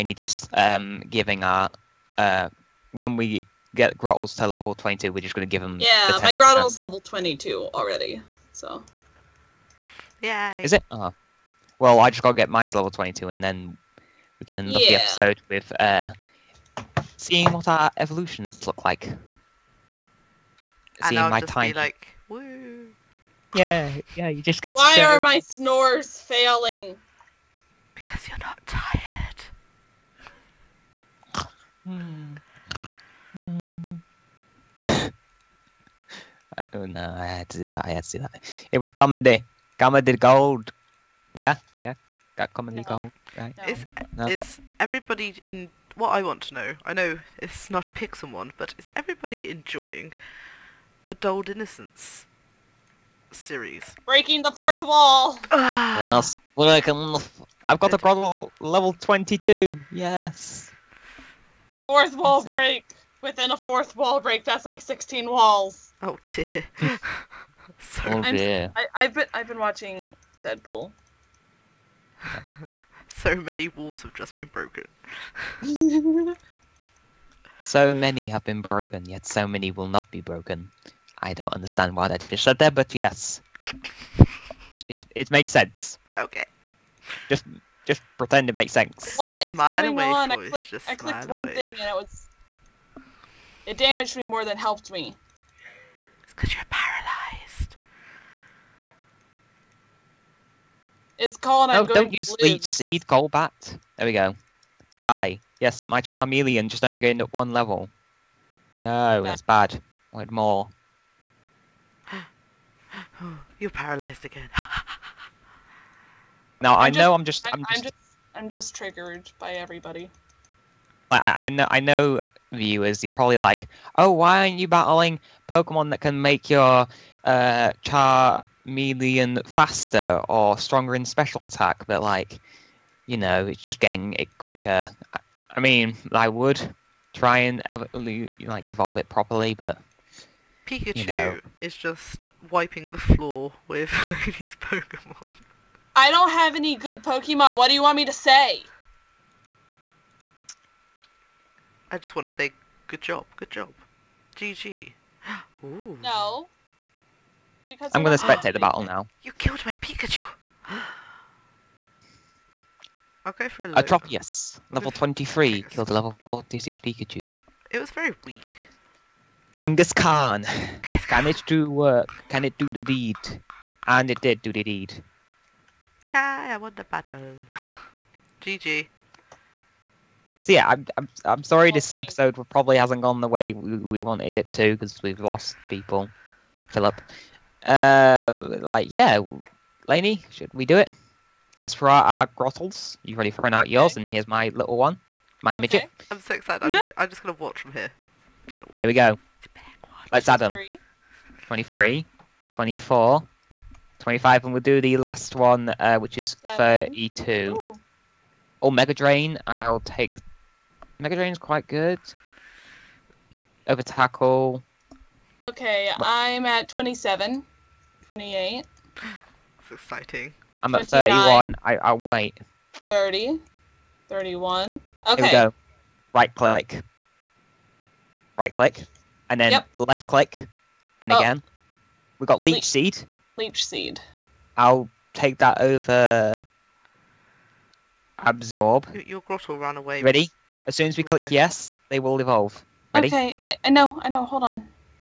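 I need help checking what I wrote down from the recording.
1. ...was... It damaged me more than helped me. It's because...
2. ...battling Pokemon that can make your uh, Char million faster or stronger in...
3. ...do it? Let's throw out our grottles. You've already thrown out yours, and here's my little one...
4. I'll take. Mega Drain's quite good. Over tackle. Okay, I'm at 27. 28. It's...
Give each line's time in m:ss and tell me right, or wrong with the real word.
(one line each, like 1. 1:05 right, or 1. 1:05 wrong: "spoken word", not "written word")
1. 1:31 right
2. 2:04 right
3. 3:10 right
4. 3:29 right.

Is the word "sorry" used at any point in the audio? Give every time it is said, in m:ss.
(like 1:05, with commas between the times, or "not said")
1:07, 3:01.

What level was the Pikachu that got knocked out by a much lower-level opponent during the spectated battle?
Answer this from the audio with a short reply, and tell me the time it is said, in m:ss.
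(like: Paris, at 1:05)
46, at 2:45.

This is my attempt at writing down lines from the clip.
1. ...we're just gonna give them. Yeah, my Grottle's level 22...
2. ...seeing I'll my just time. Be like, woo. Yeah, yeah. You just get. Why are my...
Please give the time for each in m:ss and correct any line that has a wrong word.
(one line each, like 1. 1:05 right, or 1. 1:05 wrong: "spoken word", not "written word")
1. 0:05 right
2. 0:21 right.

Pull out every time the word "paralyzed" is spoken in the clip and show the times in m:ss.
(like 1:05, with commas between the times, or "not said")
1:36, 1:53.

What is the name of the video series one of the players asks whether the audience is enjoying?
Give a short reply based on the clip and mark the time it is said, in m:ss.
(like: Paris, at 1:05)
Dulled Innocence, at 0:51.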